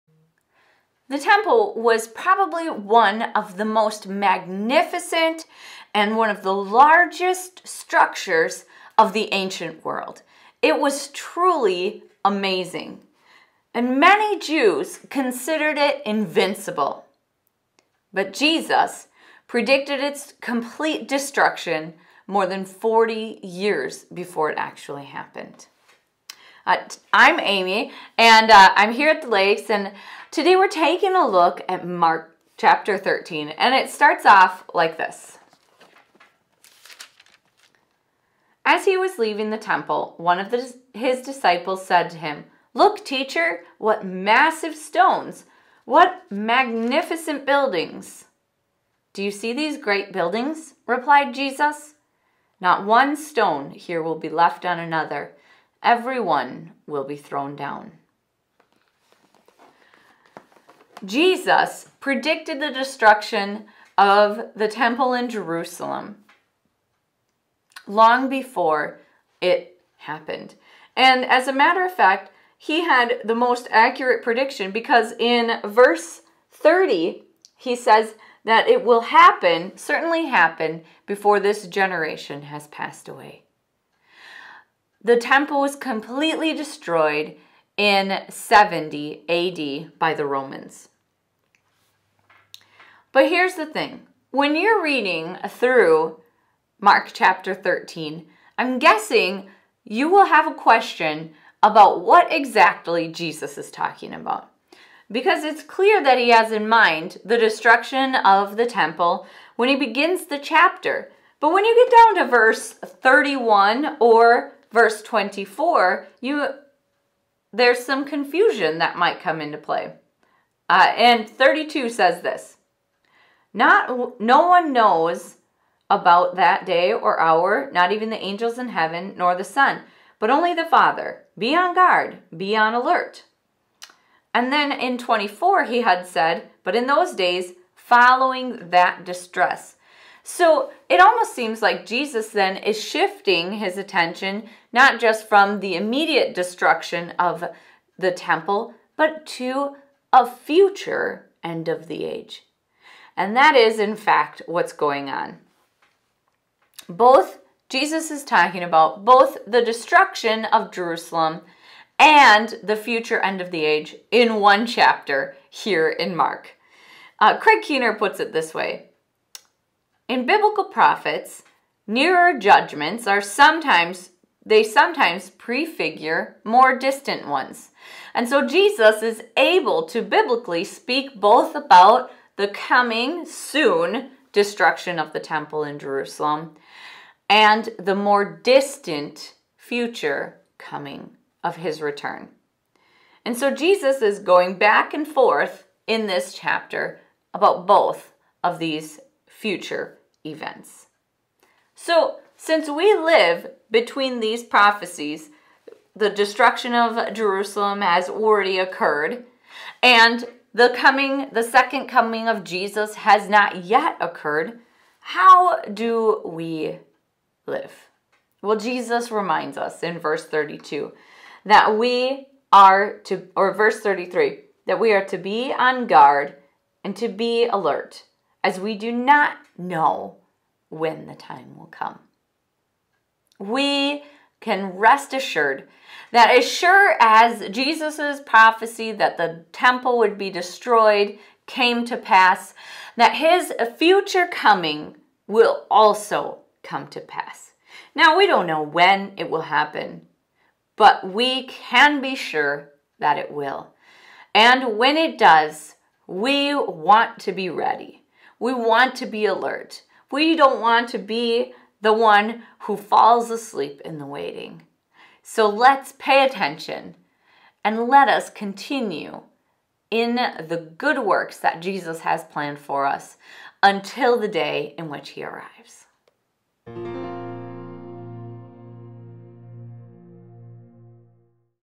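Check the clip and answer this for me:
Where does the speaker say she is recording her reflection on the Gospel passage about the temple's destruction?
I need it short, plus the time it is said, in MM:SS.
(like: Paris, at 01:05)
the lakes, at 00:29.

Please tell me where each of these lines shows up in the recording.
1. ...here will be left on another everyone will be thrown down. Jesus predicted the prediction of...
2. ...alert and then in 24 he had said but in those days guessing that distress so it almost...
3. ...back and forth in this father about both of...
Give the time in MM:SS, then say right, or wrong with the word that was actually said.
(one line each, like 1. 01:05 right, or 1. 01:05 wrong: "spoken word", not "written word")
1. 00:53 wrong: "destruction", not "prediction"
2. 02:12 wrong: "following", not "guessing"
3. 03:14 wrong: "chapter", not "father".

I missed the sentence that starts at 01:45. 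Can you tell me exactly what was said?
Because it's clear that he has in mind the destruction of the temple when he begins the chapter.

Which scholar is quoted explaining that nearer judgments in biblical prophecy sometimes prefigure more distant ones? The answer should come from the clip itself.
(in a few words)
Craig Keener.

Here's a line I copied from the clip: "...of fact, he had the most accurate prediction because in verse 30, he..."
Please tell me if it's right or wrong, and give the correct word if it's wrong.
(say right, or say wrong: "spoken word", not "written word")
right.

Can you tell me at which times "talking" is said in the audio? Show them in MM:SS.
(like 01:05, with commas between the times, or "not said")
01:43, 02:38.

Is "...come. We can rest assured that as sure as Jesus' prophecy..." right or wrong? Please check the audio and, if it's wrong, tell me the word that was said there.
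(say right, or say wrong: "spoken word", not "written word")
right.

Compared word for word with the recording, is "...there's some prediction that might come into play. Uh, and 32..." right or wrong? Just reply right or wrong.
wrong.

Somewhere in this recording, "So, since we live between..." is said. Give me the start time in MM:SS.
03:21.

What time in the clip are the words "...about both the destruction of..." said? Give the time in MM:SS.
02:38.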